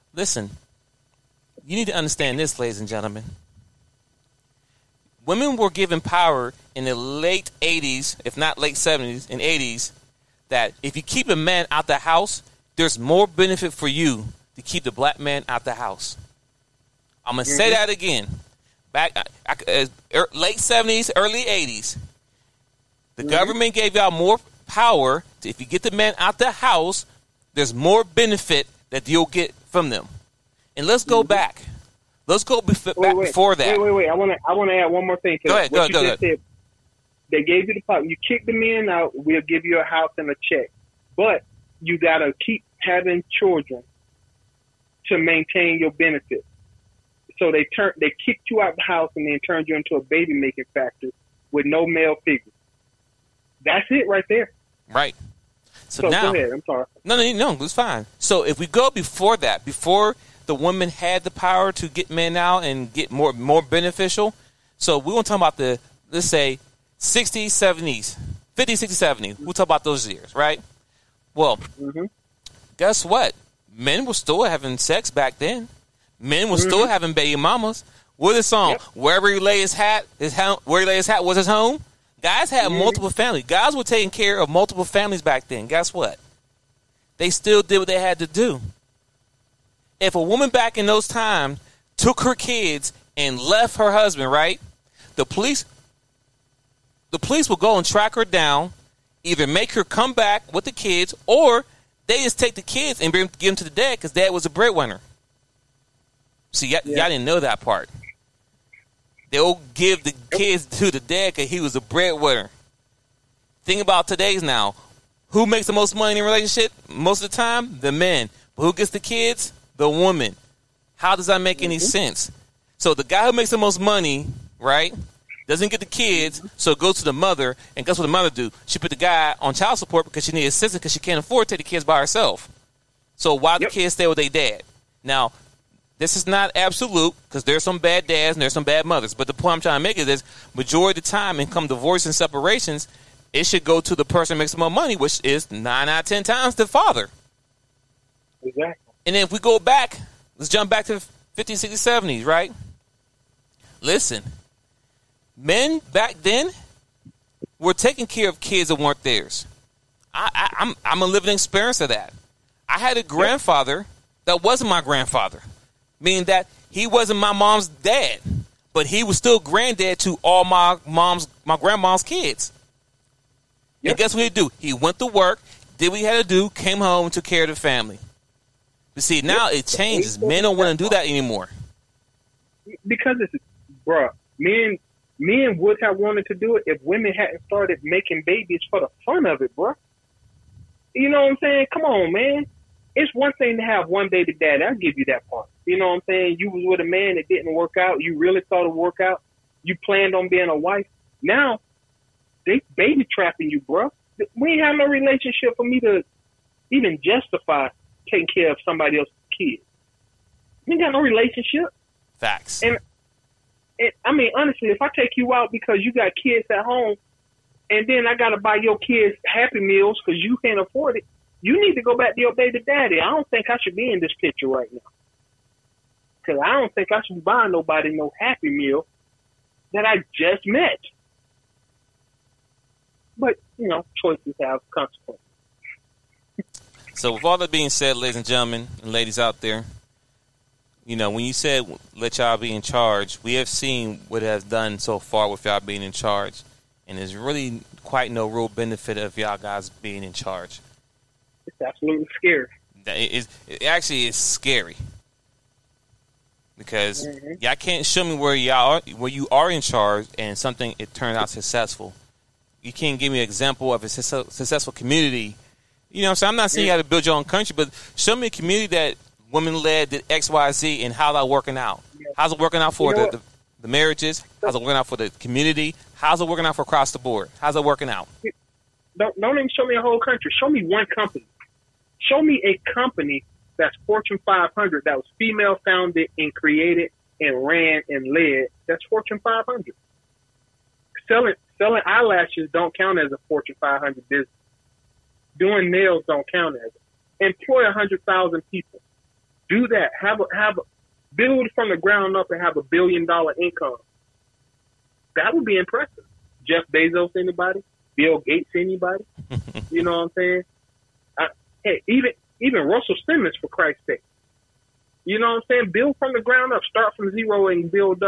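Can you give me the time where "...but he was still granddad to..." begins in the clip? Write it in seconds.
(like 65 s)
168 s.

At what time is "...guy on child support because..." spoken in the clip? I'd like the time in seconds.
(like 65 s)
128 s.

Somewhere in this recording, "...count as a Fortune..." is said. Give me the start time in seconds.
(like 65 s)
292 s.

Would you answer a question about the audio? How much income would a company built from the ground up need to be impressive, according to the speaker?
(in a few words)
billion dollar.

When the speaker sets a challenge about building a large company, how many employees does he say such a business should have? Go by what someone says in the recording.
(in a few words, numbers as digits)
100,000.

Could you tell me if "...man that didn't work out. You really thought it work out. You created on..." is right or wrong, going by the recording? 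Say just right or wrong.
wrong.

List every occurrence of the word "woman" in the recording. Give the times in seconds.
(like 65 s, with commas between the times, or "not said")
90 s, 119 s.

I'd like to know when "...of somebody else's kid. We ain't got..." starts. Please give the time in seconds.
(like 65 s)
208 s.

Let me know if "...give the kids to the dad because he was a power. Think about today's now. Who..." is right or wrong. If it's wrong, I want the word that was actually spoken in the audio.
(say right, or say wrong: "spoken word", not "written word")
wrong: "breadwinner", not "power".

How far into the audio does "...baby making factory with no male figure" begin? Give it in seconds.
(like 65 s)
50 s.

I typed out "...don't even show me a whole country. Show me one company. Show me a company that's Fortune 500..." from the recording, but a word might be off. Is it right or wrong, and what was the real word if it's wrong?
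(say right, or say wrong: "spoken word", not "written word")
right.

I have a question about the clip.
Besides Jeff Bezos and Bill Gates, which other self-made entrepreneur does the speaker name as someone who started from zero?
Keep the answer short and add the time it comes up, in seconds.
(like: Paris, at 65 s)
Russell Simmons, at 312 s.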